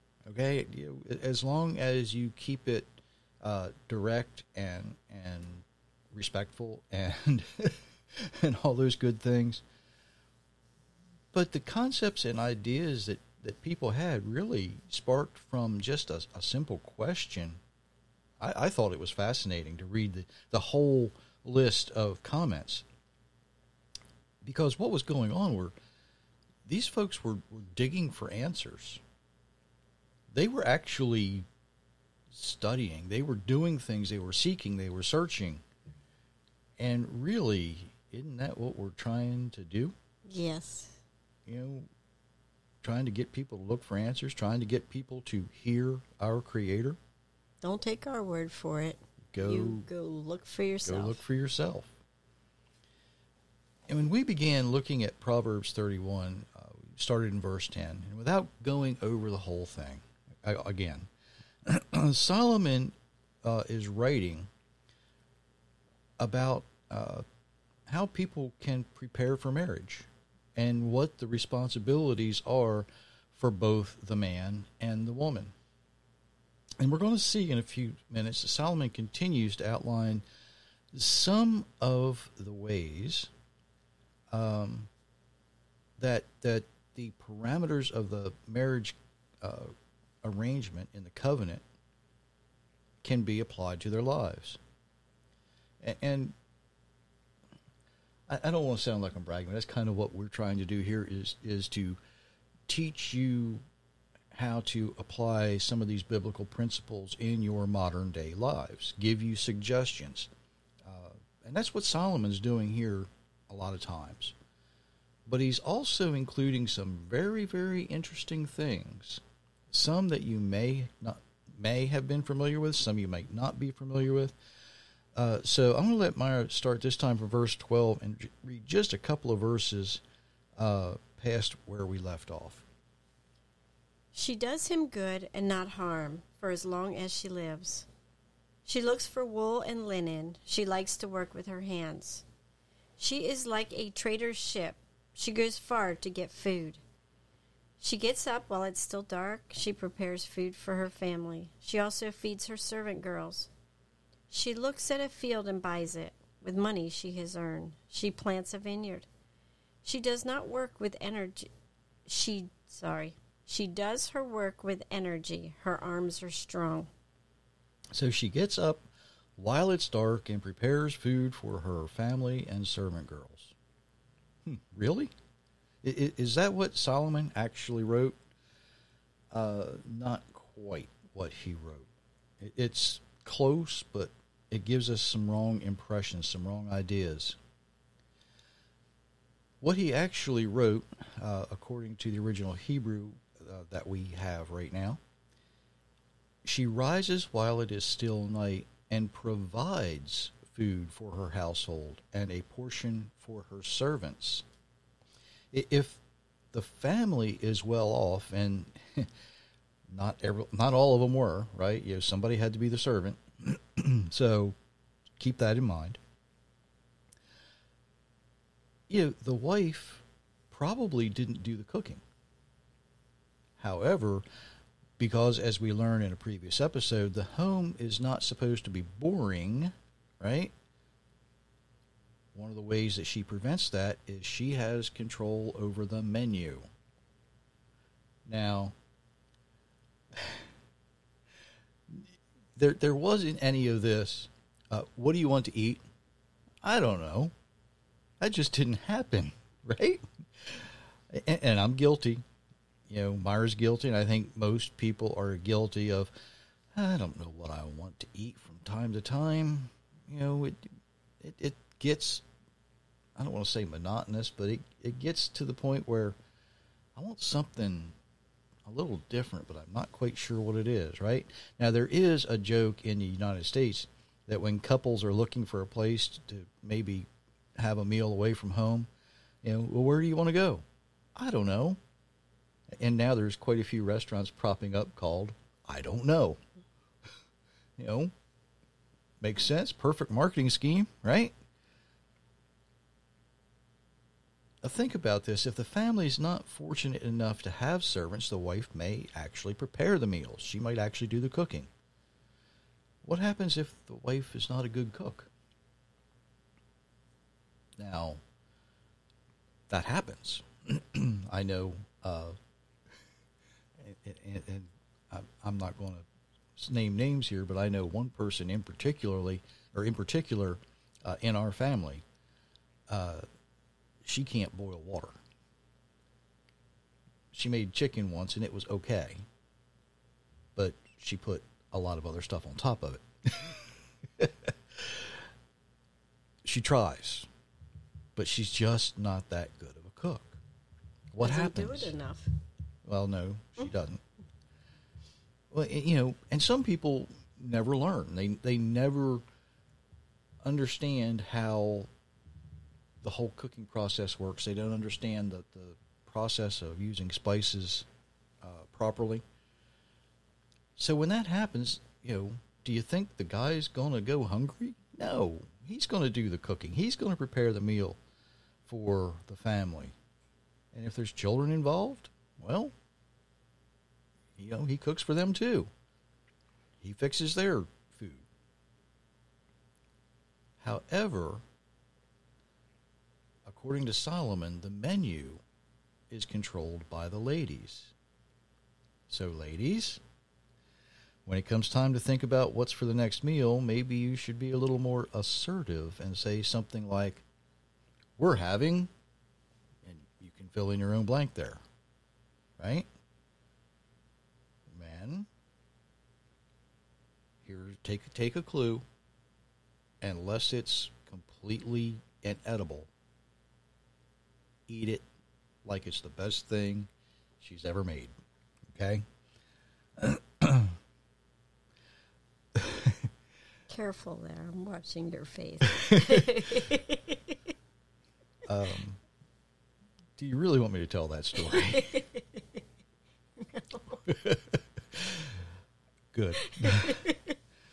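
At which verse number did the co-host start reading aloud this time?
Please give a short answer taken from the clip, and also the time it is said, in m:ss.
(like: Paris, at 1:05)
12, at 2:07.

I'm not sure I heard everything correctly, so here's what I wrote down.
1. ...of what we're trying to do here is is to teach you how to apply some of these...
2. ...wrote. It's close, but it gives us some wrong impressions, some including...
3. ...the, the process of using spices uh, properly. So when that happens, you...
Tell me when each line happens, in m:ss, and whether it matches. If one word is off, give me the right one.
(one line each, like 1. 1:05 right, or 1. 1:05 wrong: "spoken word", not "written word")
1. 1:39 right
2. 3:01 wrong: "wrong", not "including"
3. 5:55 right.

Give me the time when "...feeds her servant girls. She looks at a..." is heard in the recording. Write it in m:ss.
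2:32.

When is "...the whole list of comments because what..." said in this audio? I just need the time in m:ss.
0:20.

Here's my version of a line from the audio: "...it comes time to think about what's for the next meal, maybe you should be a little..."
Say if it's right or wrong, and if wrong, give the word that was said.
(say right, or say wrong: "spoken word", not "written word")
right.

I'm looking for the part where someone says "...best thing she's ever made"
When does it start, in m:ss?
6:56.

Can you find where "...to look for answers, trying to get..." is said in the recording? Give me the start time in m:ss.
0:43.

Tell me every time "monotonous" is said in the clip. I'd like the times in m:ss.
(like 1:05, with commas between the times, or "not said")
4:23.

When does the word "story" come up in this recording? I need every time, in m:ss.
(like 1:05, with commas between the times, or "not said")
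7:11.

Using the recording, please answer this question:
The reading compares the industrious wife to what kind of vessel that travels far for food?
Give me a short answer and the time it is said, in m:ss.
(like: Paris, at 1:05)
A trader's ship, at 2:23.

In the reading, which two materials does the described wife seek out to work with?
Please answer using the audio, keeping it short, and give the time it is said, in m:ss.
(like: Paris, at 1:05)
Wool and linen, at 2:19.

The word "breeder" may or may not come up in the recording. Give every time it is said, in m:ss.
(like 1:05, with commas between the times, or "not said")
not said.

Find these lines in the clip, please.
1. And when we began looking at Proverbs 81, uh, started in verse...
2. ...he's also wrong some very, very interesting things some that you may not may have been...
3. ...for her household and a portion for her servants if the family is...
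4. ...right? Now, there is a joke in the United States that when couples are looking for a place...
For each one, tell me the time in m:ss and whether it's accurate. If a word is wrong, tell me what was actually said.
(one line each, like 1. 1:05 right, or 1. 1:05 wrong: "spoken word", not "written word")
1. 0:53 wrong: "31", not "81"
2. 1:55 wrong: "including", not "wrong"
3. 3:20 right
4. 4:30 right.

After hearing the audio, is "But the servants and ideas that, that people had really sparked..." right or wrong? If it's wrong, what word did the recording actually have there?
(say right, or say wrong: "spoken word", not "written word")
wrong: "concepts", not "servants".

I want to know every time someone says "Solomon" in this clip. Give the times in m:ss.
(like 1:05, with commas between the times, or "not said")
1:02, 1:18, 1:51, 2:56, 6:23.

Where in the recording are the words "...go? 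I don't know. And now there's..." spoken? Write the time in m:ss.
4:40.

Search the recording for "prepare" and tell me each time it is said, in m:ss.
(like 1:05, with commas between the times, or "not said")
1:08, 2:29, 2:50, 4:59, 6:07.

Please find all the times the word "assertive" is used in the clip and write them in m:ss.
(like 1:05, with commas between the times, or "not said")
6:35.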